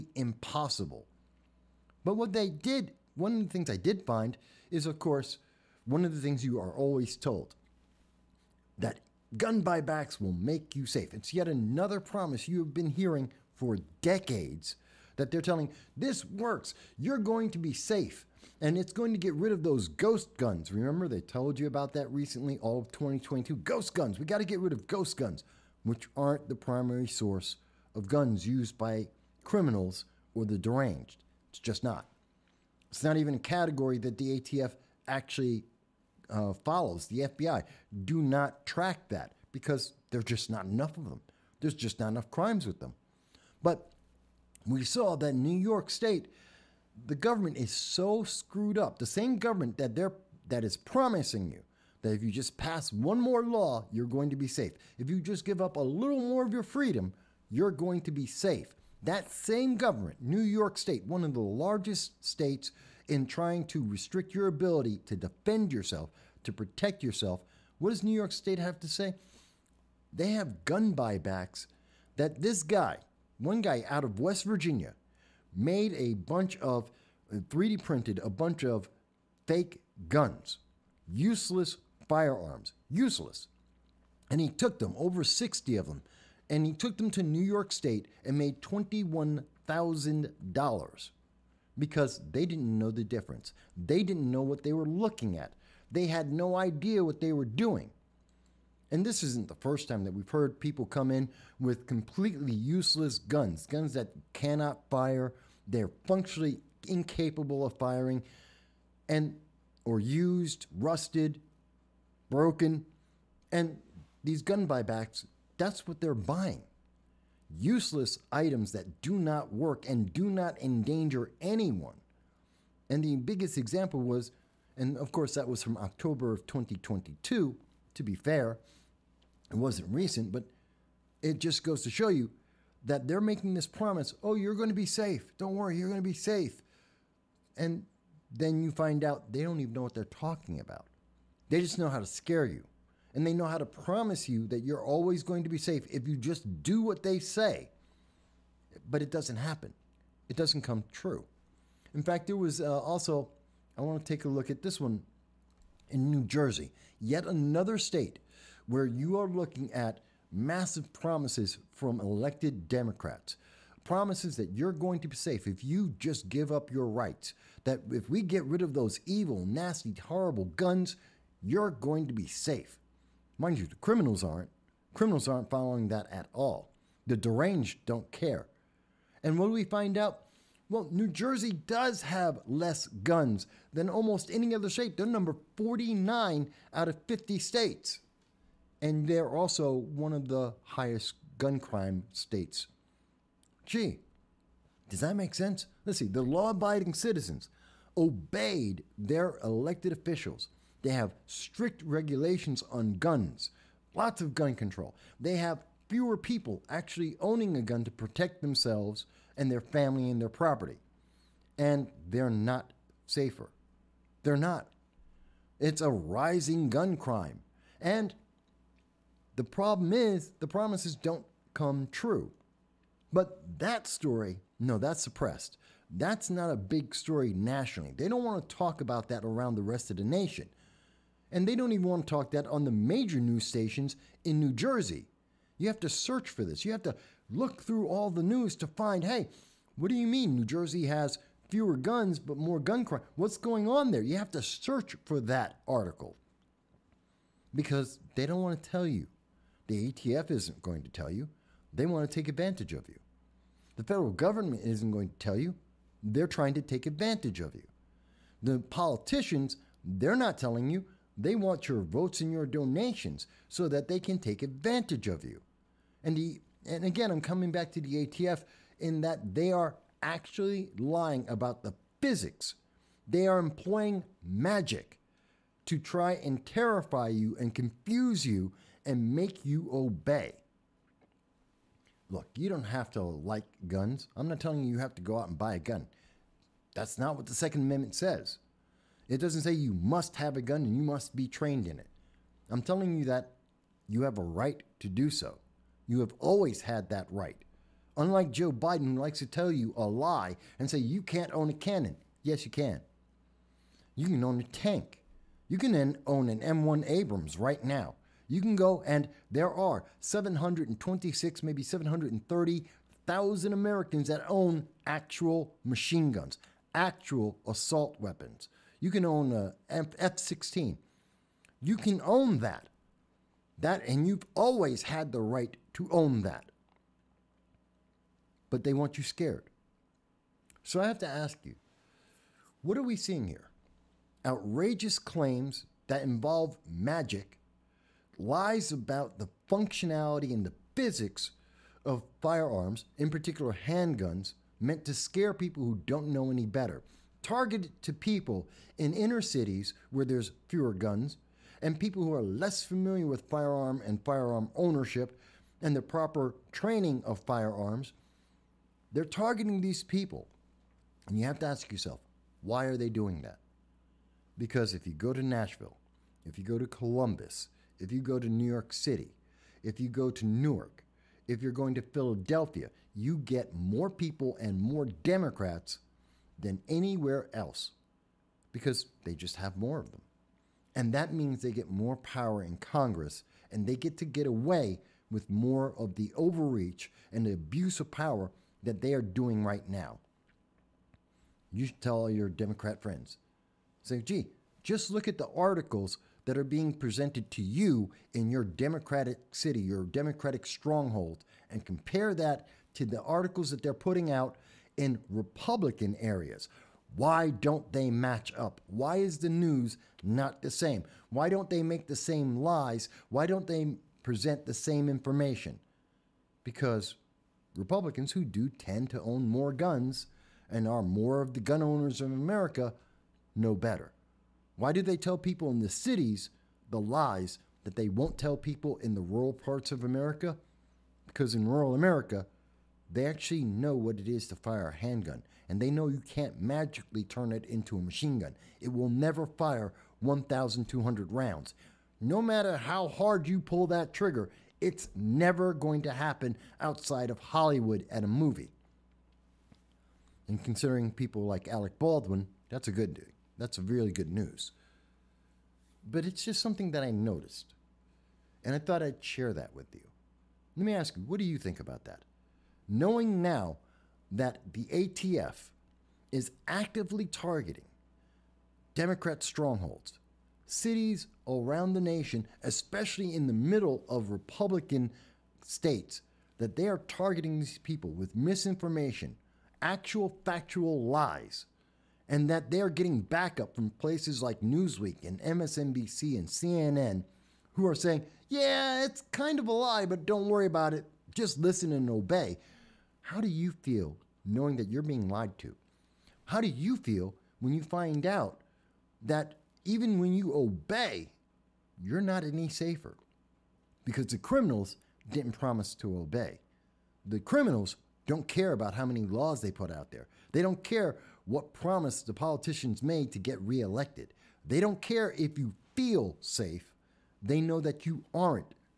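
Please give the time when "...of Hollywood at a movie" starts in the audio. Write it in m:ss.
7:27.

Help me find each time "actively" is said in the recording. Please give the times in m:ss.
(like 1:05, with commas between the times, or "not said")
7:46.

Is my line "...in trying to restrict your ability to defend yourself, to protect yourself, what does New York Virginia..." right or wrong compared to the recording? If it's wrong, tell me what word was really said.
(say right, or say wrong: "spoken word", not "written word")
wrong: "State", not "Virginia".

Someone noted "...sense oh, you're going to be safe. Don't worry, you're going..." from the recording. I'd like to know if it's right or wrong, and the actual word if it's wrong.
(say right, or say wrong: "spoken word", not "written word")
wrong: "promise", not "sense".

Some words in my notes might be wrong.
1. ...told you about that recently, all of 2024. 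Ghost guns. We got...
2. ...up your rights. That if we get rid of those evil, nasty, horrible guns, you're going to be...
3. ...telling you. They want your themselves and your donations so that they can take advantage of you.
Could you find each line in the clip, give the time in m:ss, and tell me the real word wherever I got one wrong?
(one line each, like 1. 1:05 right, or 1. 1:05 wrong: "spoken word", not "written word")
1. 0:21 wrong: "2022", not "2024"
2. 2:46 right
3. 4:20 wrong: "votes", not "themselves".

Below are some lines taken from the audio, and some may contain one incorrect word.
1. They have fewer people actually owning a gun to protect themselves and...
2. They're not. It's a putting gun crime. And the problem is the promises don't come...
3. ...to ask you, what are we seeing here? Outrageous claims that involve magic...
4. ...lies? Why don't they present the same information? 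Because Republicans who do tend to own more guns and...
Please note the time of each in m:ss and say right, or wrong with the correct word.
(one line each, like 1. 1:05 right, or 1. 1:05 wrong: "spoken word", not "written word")
1. 3:25 right
2. 3:34 wrong: "rising", not "putting"
3. 5:30 right
4. 6:52 right.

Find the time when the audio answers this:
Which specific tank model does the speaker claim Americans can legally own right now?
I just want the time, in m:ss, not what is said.
5:06.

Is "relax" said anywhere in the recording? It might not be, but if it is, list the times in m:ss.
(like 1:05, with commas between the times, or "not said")
not said.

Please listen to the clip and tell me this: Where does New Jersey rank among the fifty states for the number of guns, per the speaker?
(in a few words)
49.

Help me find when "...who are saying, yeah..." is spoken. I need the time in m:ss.
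8:07.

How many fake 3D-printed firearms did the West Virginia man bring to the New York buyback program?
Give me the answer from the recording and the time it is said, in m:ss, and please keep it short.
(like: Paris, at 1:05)
Over 60, at 1:24.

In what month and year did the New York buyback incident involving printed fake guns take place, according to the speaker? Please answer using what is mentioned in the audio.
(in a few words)
October 2022.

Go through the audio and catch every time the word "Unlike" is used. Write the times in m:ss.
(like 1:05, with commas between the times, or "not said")
4:57.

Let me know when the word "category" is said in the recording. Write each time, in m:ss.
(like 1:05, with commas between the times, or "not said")
0:33.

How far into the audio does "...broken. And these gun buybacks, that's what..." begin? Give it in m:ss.
1:52.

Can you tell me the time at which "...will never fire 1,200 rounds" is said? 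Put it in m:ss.
7:18.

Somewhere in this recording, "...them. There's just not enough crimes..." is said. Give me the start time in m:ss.
0:41.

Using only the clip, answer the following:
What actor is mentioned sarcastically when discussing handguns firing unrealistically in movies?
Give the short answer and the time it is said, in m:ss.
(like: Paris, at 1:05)
Alec Baldwin, at 7:31.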